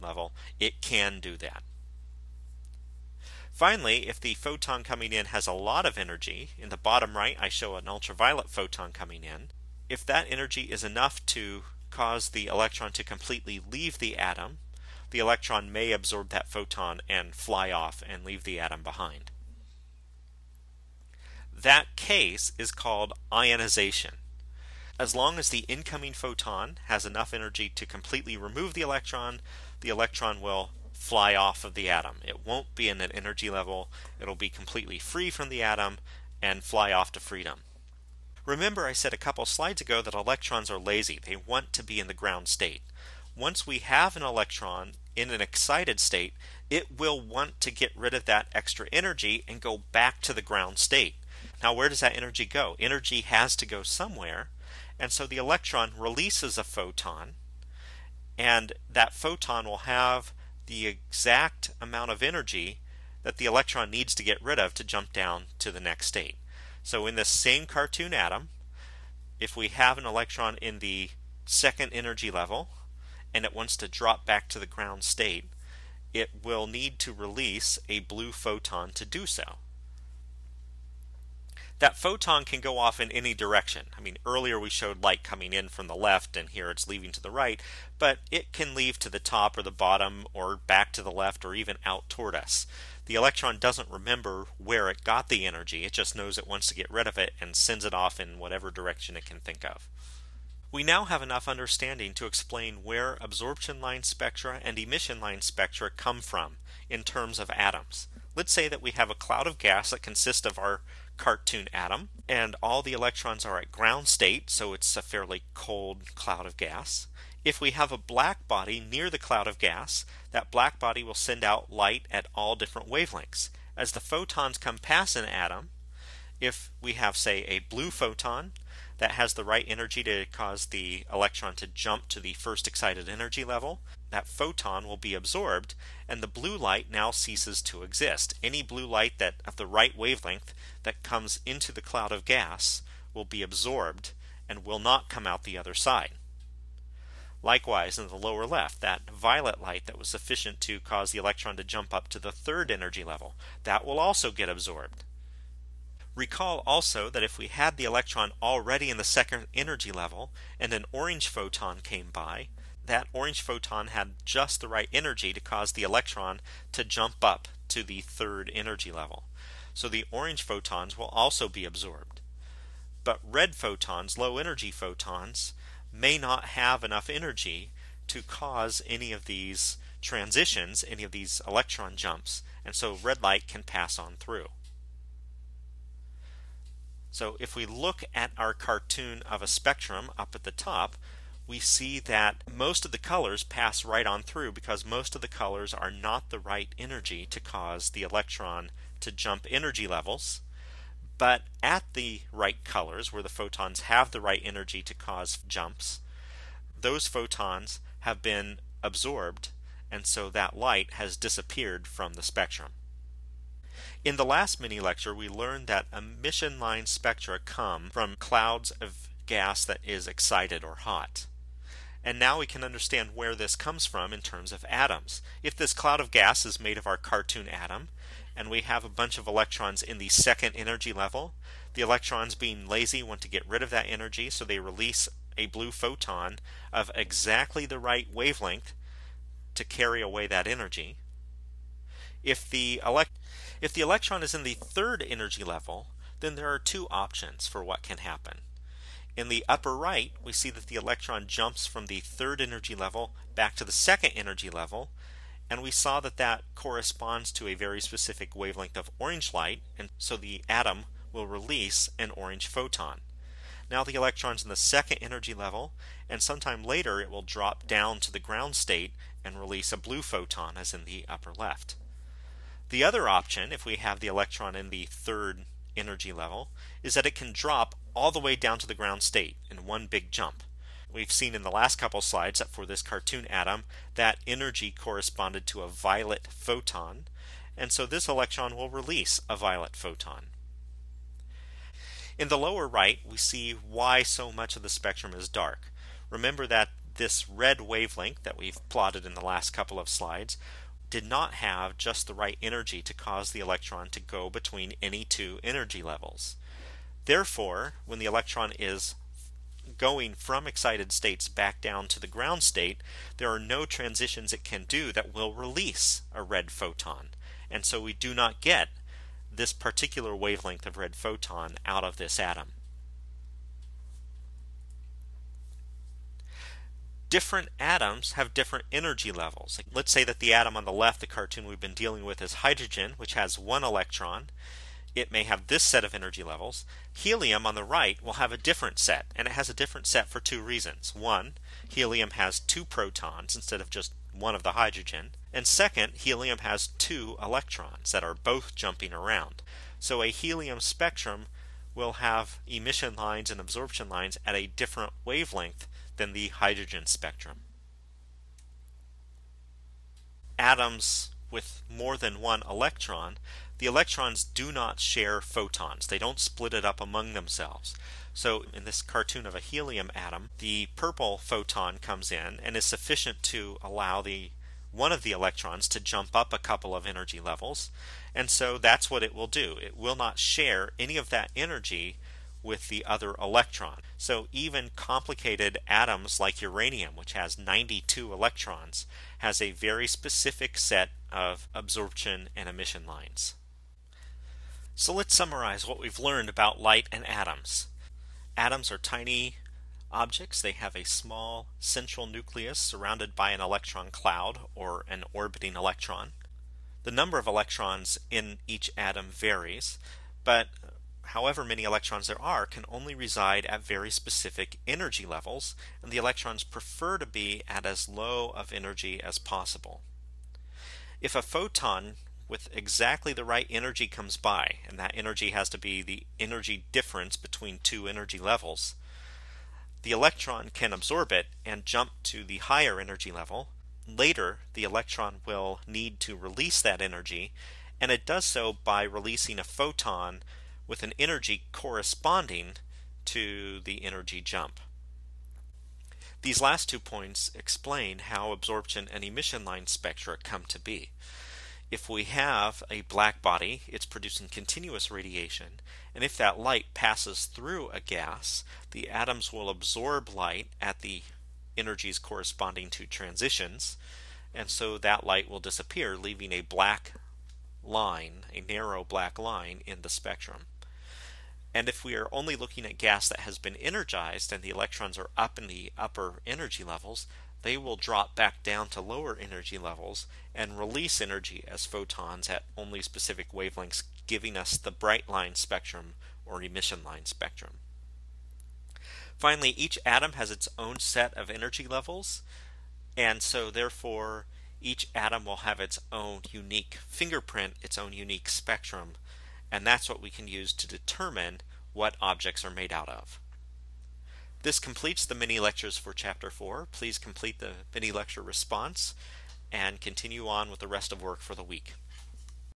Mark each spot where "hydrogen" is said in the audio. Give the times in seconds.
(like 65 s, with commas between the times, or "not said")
332 s, 344 s, 356 s.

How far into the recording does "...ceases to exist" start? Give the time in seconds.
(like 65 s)
137 s.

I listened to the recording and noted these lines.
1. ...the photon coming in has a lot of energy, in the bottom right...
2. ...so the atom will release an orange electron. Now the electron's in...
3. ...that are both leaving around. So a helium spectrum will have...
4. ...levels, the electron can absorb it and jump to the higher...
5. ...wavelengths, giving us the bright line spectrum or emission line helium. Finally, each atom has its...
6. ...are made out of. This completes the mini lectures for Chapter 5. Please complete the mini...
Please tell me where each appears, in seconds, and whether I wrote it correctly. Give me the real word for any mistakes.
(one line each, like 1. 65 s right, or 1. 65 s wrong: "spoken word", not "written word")
1. 4 s right
2. 259 s wrong: "photon", not "electron"
3. 347 s wrong: "jumping", not "leaving"
4. 428 s right
5. 483 s wrong: "spectrum", not "helium"
6. 502 s wrong: "4", not "5".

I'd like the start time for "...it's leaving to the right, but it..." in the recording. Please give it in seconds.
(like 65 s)
86 s.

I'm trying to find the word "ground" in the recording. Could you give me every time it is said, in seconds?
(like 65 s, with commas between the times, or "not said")
42 s, 50 s, 74 s, 113 s, 268 s, 278 s, 312 s.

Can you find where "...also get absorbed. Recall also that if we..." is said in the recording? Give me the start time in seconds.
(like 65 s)
153 s.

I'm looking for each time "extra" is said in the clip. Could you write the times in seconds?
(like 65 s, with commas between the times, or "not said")
48 s.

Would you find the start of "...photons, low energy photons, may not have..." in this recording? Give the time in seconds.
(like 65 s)
173 s.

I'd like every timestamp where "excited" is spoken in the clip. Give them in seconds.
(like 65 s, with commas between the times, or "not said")
45 s, 132 s, 220 s, 310 s.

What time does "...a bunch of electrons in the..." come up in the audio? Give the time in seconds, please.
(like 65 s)
228 s.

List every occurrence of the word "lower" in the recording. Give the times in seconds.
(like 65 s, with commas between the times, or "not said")
148 s, 292 s, 478 s.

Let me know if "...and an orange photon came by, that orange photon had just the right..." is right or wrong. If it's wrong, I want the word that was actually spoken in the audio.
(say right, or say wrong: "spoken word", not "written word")
right.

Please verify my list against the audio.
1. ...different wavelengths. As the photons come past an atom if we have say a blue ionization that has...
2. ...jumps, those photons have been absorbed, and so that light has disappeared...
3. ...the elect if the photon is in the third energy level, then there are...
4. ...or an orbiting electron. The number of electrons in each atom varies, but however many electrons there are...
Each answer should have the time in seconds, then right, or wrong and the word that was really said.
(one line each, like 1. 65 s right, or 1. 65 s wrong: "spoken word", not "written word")
1. 122 s wrong: "photon", not "ionization"
2. 205 s right
3. 242 s wrong: "electron", not "photon"
4. 404 s right.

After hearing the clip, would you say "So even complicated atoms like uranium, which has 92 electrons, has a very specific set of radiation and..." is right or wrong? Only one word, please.
wrong.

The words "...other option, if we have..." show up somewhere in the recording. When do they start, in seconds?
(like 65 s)
272 s.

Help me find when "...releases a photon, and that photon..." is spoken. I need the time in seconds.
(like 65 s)
55 s.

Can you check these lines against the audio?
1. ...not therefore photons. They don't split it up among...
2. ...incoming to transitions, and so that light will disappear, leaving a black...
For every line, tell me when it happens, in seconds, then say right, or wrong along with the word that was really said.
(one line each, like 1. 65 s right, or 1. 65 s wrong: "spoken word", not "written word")
1. 364 s wrong: "share", not "therefore"
2. 461 s wrong: "corresponding", not "incoming".